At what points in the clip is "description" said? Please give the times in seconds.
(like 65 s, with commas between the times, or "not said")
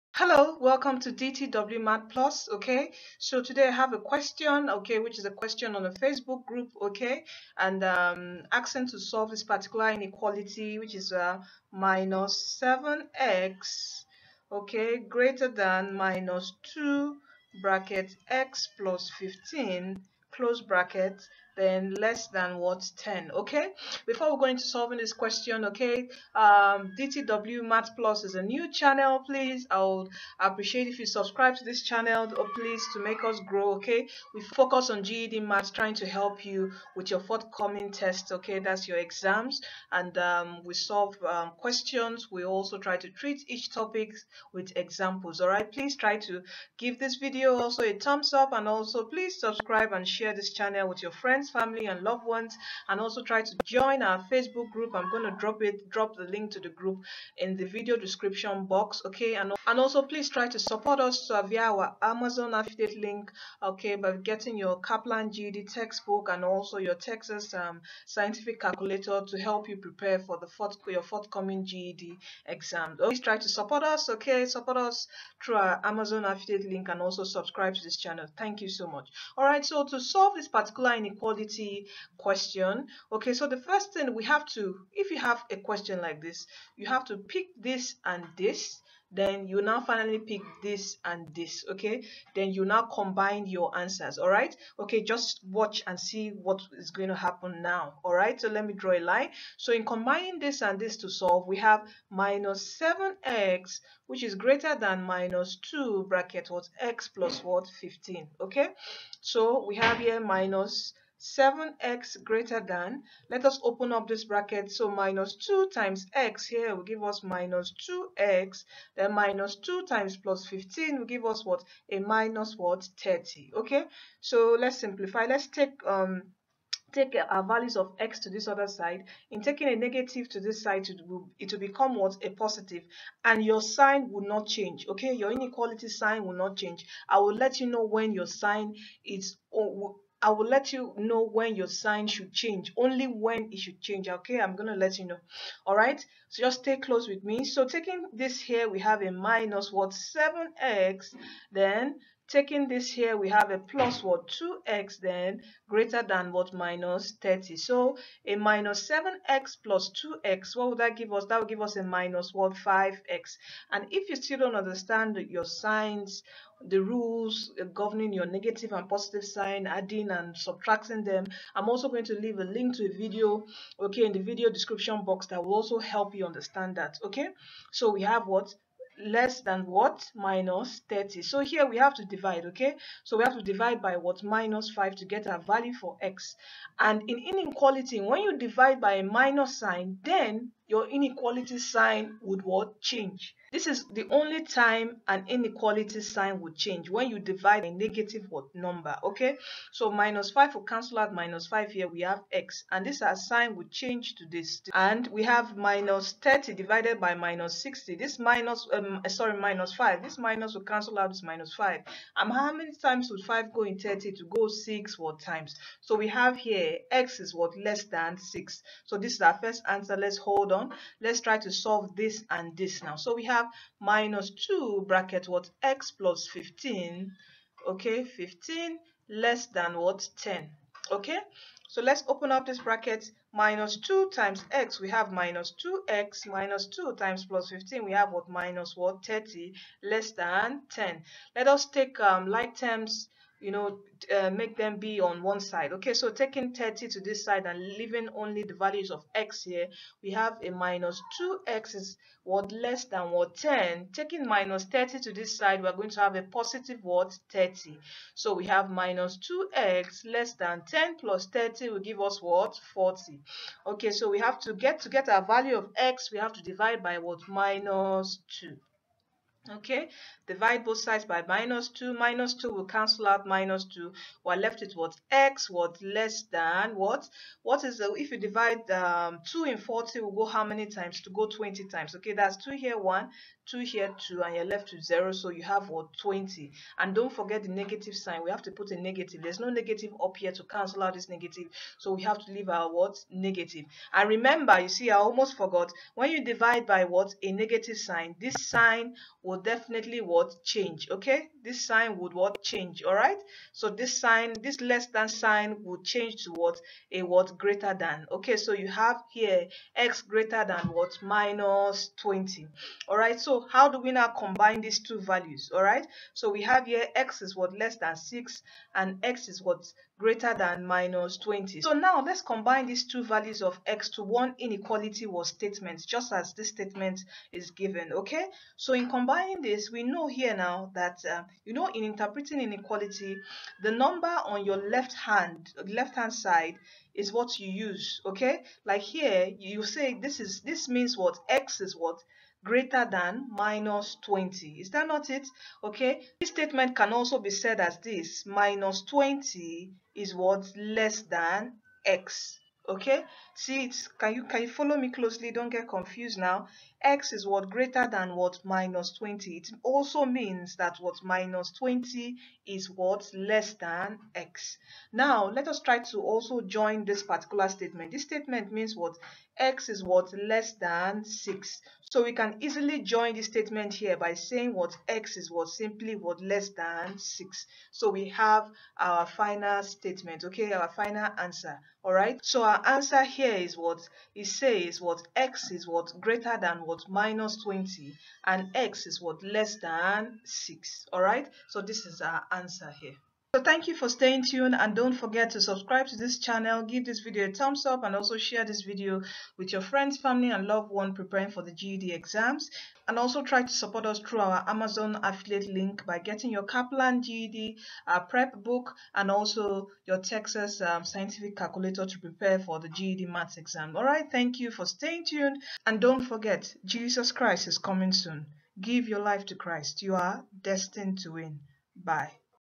57 s, 174 s.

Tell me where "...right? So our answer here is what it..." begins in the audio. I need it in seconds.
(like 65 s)
381 s.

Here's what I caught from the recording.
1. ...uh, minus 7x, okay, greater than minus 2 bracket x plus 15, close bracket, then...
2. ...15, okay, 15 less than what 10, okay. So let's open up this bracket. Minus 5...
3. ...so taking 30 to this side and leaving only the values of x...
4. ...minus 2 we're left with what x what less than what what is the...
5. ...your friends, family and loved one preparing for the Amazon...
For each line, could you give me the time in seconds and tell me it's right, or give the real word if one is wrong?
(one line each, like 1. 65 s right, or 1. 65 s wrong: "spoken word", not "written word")
1. 11 s right
2. 226 s wrong: "2", not "5"
3. 245 s right
4. 273 s right
5. 399 s wrong: "GED", not "Amazon".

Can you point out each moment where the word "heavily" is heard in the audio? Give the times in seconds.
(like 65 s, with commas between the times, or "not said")
not said.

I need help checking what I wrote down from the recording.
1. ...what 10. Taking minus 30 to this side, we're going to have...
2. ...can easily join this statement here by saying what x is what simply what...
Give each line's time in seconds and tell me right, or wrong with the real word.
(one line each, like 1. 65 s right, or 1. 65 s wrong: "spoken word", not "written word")
1. 253 s right
2. 372 s right.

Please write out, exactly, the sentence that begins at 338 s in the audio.
Like here, you say this is, this means what x is what greater than minus 20.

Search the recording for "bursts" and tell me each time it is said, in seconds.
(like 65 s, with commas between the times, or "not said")
not said.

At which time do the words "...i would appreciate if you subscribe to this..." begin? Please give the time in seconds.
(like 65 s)
29 s.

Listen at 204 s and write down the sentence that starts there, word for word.
And we have minus 30 divided by minus 60.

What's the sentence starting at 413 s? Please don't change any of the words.
Alright, thank you for staying tuned and don't forget Jesus Christ is coming soon.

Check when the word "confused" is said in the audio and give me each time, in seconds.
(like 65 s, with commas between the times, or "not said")
355 s.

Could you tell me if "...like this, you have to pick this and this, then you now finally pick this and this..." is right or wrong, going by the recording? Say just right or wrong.
right.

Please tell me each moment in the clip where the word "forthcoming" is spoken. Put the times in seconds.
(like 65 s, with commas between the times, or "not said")
37 s, 71 s.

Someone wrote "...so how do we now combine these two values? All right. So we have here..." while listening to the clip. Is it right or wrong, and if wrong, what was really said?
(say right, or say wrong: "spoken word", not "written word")
right.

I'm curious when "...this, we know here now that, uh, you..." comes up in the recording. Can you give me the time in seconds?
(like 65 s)
329 s.